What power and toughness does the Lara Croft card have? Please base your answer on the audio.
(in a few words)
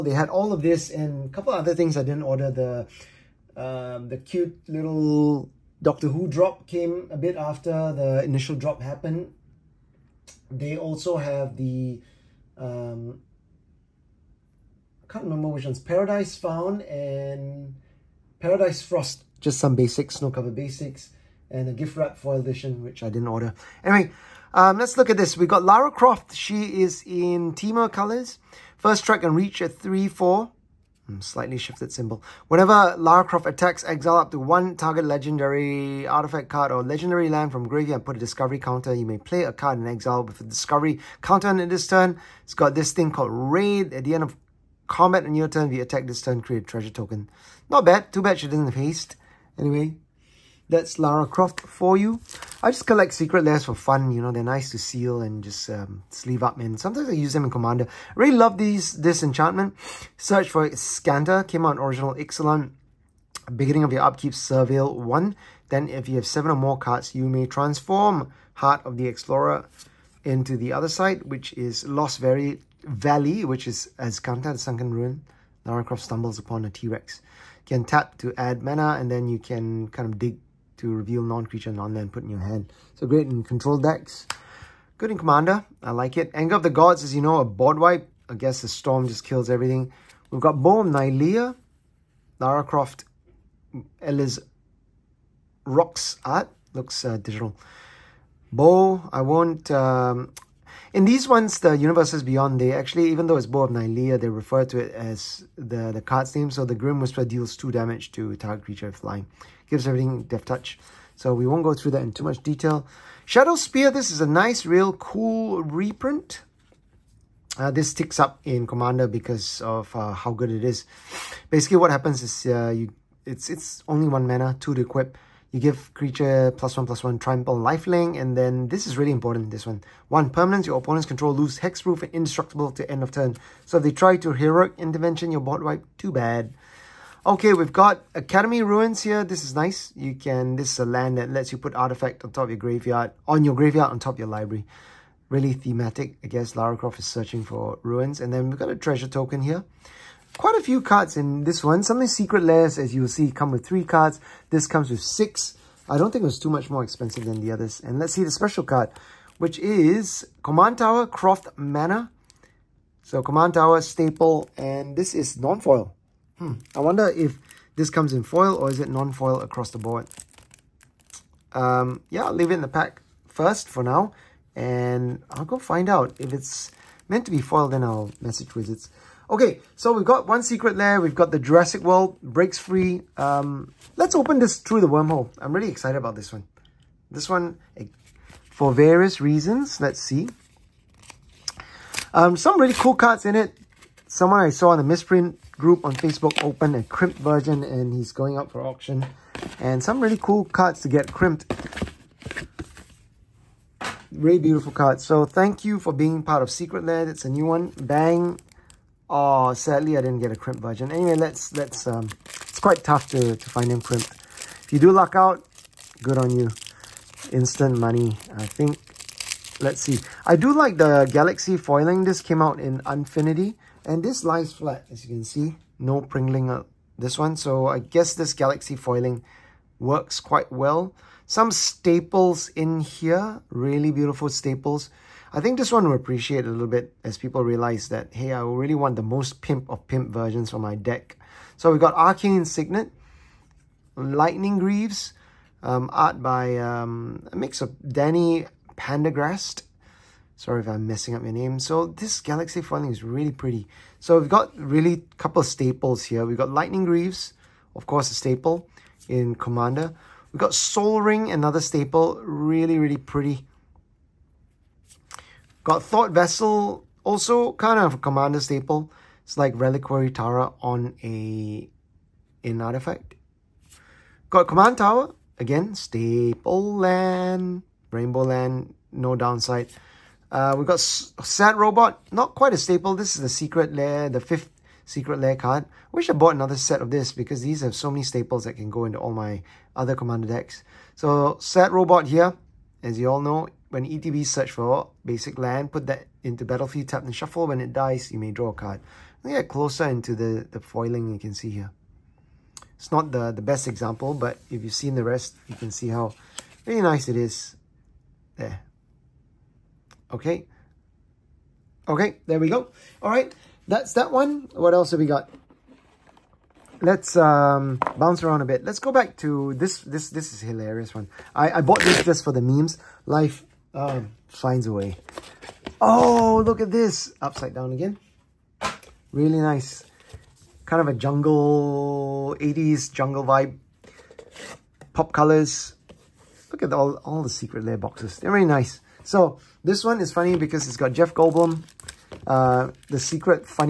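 3/4.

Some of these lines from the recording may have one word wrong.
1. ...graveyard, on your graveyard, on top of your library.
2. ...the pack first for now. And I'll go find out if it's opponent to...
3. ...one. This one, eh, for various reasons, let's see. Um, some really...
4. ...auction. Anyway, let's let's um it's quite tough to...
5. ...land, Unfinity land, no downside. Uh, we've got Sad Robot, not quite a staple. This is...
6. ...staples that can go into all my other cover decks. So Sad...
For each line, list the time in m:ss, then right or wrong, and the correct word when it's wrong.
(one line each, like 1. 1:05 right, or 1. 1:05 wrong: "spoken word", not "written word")
1. 2:22 right
2. 2:52 wrong: "meant", not "opponent"
3. 3:06 right
4. 3:30 wrong: "version", not "auction"
5. 4:36 wrong: "Rainbow", not "Unfinity"
6. 4:48 wrong: "commander", not "cover".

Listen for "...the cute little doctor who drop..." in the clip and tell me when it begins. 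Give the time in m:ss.
0:04.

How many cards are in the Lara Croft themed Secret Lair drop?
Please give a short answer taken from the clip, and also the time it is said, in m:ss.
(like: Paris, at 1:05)
6, at 2:35.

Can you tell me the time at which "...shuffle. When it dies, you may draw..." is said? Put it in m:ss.
4:57.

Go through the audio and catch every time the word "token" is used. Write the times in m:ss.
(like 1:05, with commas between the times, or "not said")
0:46, 2:29.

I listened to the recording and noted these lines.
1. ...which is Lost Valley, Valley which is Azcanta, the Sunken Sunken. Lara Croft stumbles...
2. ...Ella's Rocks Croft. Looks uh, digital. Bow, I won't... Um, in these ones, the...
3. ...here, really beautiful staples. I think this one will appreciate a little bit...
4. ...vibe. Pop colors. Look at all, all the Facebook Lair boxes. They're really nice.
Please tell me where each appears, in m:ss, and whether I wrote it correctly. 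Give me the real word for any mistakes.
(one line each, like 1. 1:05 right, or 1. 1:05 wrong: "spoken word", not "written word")
1. 1:11 wrong: "Ruin", not "Sunken"
2. 1:34 wrong: "Art", not "Croft"
3. 3:52 right
4. 5:33 wrong: "Secret", not "Facebook".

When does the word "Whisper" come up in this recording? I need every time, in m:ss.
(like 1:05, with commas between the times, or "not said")
1:47.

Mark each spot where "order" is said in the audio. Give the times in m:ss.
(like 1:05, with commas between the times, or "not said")
0:02, 0:23.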